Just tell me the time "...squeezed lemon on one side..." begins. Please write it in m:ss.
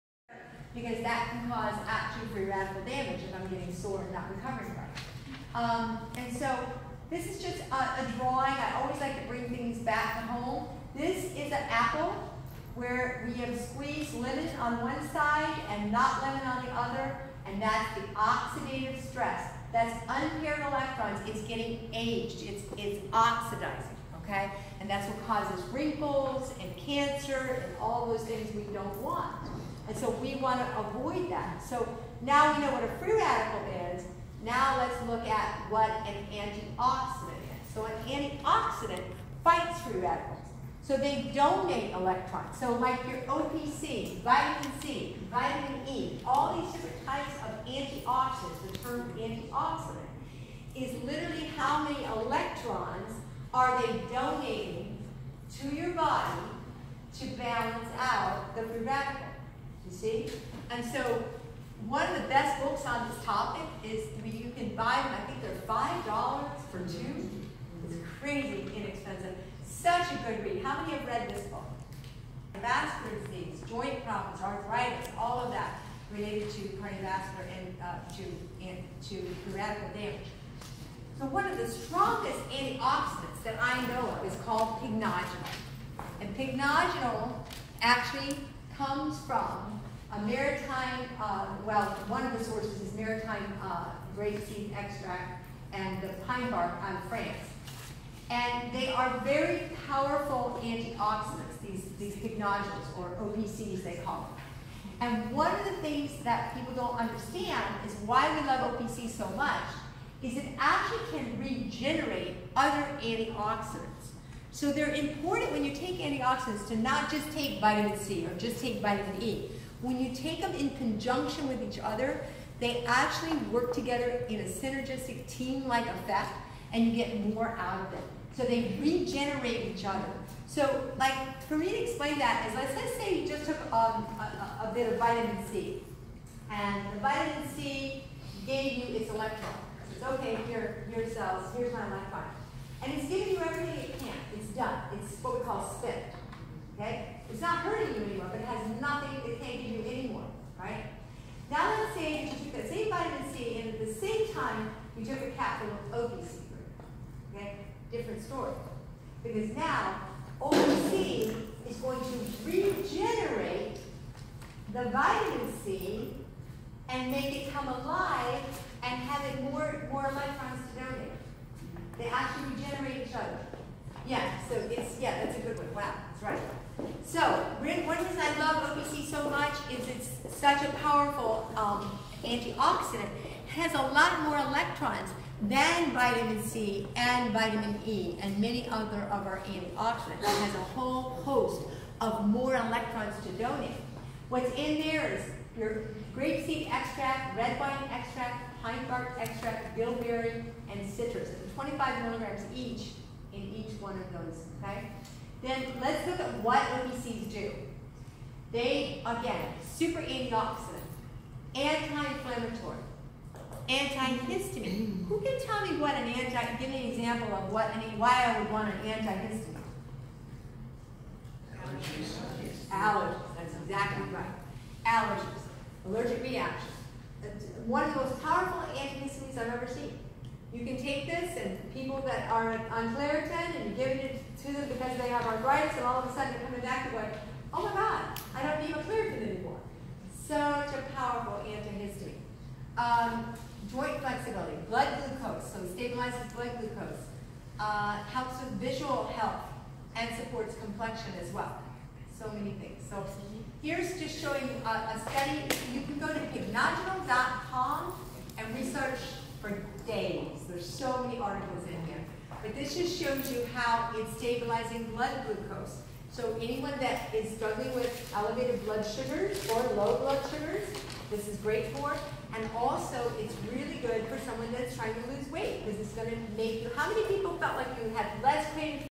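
0:13.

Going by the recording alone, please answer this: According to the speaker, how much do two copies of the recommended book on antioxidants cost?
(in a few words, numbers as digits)
$5.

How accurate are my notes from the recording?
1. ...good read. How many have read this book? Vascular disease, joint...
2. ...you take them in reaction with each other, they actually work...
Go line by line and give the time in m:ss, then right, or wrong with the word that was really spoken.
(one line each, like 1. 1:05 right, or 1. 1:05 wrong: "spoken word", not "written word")
1. 1:10 right
2. 1:59 wrong: "conjunction", not "reaction".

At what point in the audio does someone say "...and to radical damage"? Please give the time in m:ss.
1:18.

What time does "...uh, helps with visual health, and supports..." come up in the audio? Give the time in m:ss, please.
4:07.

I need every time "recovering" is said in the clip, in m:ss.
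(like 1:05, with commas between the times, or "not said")
0:04.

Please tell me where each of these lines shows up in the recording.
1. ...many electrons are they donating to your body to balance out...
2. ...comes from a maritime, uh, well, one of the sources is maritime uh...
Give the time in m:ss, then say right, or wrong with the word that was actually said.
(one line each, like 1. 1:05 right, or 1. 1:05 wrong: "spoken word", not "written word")
1. 0:51 right
2. 1:28 right.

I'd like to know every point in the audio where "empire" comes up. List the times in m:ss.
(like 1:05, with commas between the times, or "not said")
not said.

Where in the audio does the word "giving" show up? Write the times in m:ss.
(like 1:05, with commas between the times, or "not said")
2:23, 3:53.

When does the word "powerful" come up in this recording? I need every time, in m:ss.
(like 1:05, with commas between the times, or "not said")
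1:39, 3:00, 3:48, 4:00.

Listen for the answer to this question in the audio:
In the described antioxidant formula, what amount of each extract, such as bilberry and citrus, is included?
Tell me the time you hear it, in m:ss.
3:21.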